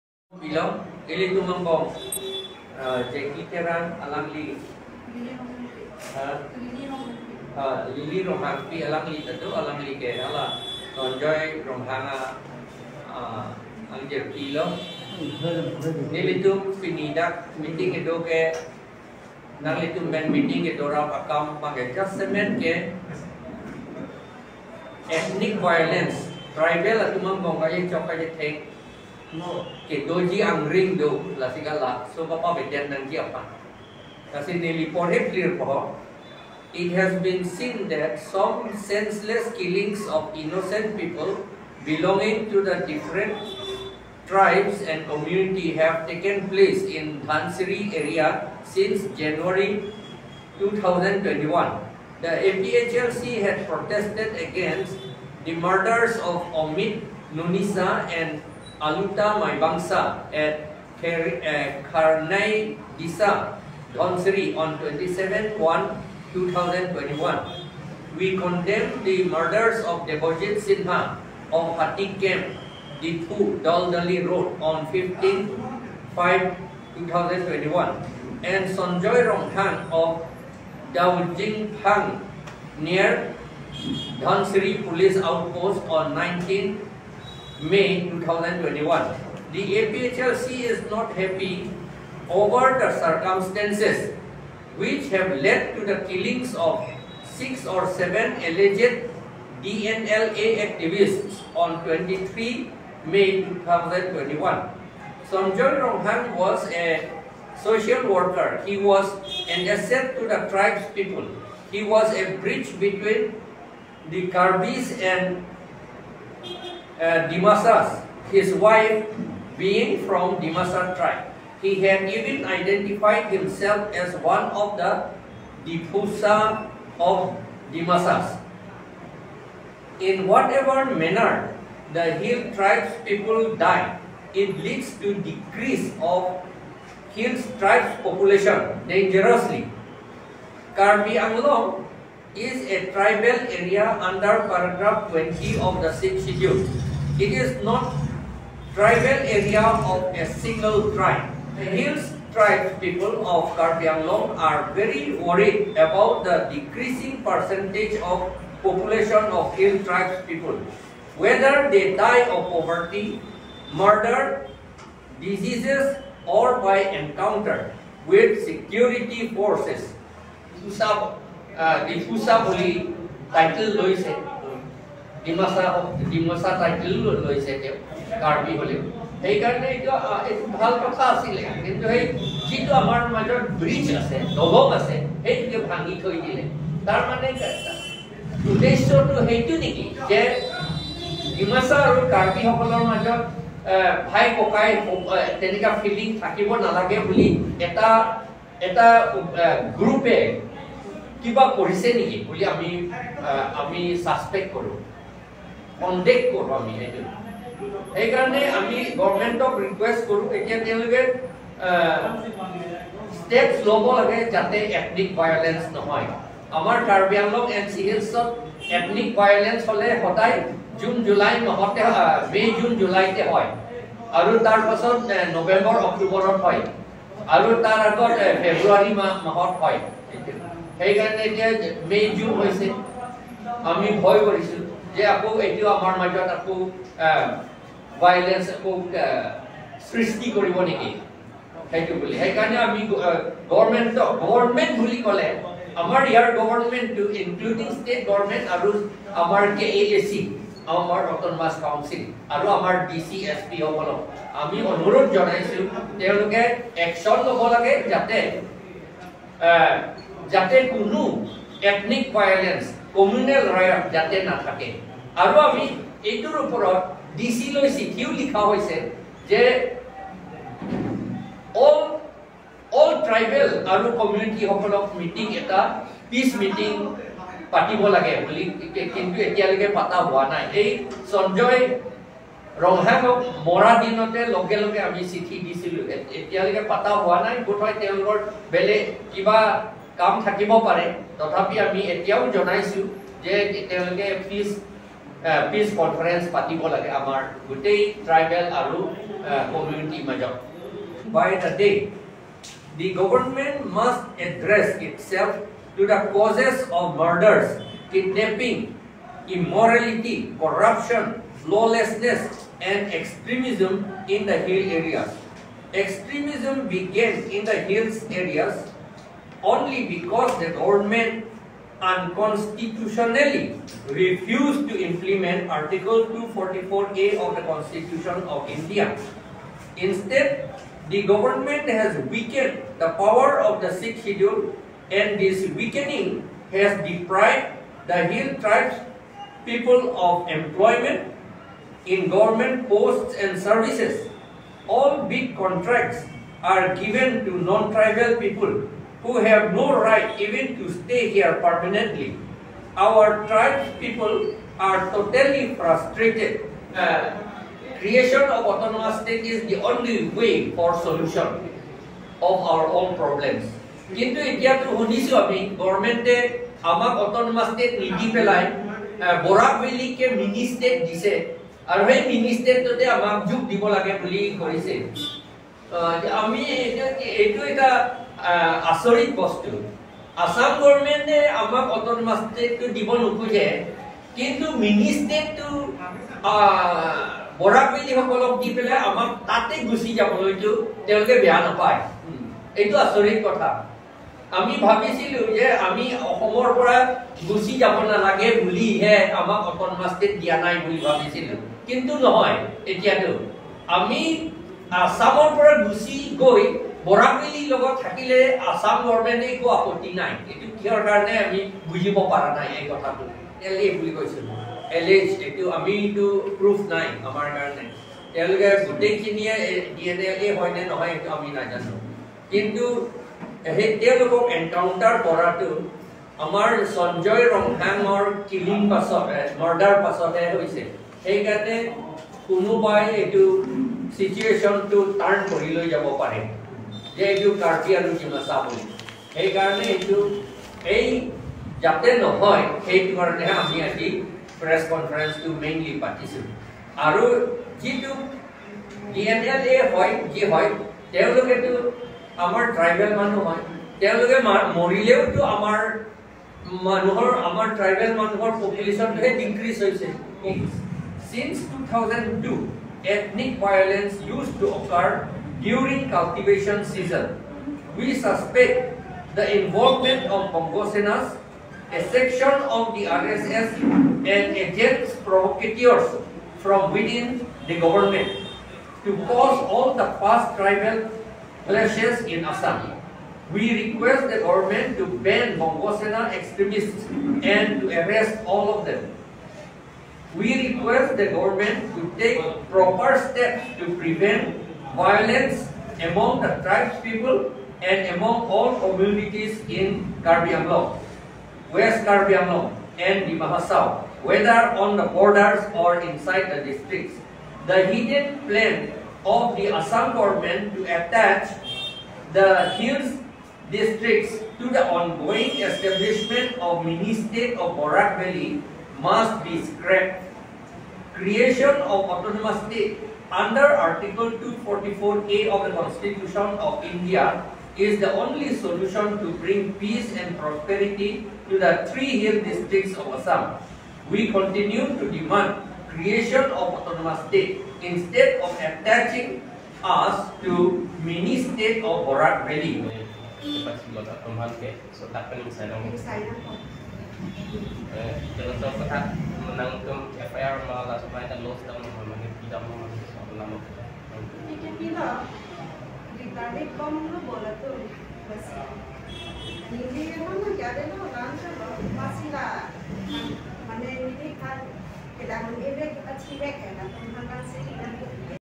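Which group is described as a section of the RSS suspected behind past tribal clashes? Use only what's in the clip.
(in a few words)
Bongosena.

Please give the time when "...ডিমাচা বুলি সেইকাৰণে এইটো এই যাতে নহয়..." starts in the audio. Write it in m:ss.
7:18.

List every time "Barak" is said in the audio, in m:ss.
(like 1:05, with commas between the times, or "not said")
8:37, 9:01.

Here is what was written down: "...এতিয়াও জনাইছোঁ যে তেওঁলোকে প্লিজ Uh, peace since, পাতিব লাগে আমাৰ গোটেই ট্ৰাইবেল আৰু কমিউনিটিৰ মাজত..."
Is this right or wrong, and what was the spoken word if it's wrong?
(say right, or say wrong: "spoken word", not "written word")
wrong: "conference", not "since".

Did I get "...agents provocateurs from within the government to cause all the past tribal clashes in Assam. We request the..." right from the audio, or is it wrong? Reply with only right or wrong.
right.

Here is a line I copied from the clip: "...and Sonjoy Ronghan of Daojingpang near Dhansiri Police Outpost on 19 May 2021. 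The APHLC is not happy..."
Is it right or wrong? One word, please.
right.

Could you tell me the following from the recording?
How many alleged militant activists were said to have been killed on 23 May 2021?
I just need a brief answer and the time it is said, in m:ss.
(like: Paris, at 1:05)
6 or 7, at 1:37.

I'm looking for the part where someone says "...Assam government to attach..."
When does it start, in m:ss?
8:29.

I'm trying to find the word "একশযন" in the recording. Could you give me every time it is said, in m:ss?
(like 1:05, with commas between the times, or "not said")
4:16.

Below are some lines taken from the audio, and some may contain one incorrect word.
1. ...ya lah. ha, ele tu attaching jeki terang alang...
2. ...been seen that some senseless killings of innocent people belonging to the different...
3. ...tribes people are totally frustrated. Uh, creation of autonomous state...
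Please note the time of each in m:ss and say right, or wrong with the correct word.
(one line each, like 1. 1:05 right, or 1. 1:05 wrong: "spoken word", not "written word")
1. 0:01 wrong: "mengkong", not "attaching"
2. 0:37 right
3. 5:53 right.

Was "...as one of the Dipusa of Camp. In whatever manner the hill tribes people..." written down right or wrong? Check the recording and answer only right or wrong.
wrong.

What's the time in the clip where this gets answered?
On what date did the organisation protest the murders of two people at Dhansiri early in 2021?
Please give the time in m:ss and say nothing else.
1:06.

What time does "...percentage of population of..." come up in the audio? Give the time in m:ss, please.
2:37.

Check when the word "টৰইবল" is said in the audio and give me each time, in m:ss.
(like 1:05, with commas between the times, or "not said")
4:33, 4:58, 7:32, 7:37.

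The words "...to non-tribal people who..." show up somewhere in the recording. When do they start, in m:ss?
5:47.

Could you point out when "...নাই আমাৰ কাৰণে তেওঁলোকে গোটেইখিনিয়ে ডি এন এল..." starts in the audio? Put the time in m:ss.
6:56.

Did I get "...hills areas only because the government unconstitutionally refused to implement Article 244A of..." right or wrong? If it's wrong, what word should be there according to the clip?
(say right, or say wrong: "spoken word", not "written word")
right.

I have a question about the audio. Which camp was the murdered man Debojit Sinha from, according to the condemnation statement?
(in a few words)
Hatik Camp.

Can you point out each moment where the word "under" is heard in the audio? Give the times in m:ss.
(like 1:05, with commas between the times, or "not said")
2:23, 8:43.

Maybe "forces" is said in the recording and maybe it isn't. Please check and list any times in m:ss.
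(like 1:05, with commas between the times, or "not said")
2:49.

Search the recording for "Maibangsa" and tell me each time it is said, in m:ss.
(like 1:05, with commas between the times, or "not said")
0:59.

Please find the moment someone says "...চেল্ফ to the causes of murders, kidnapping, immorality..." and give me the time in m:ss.
5:05.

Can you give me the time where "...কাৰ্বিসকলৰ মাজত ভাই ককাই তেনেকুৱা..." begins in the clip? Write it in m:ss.
3:12.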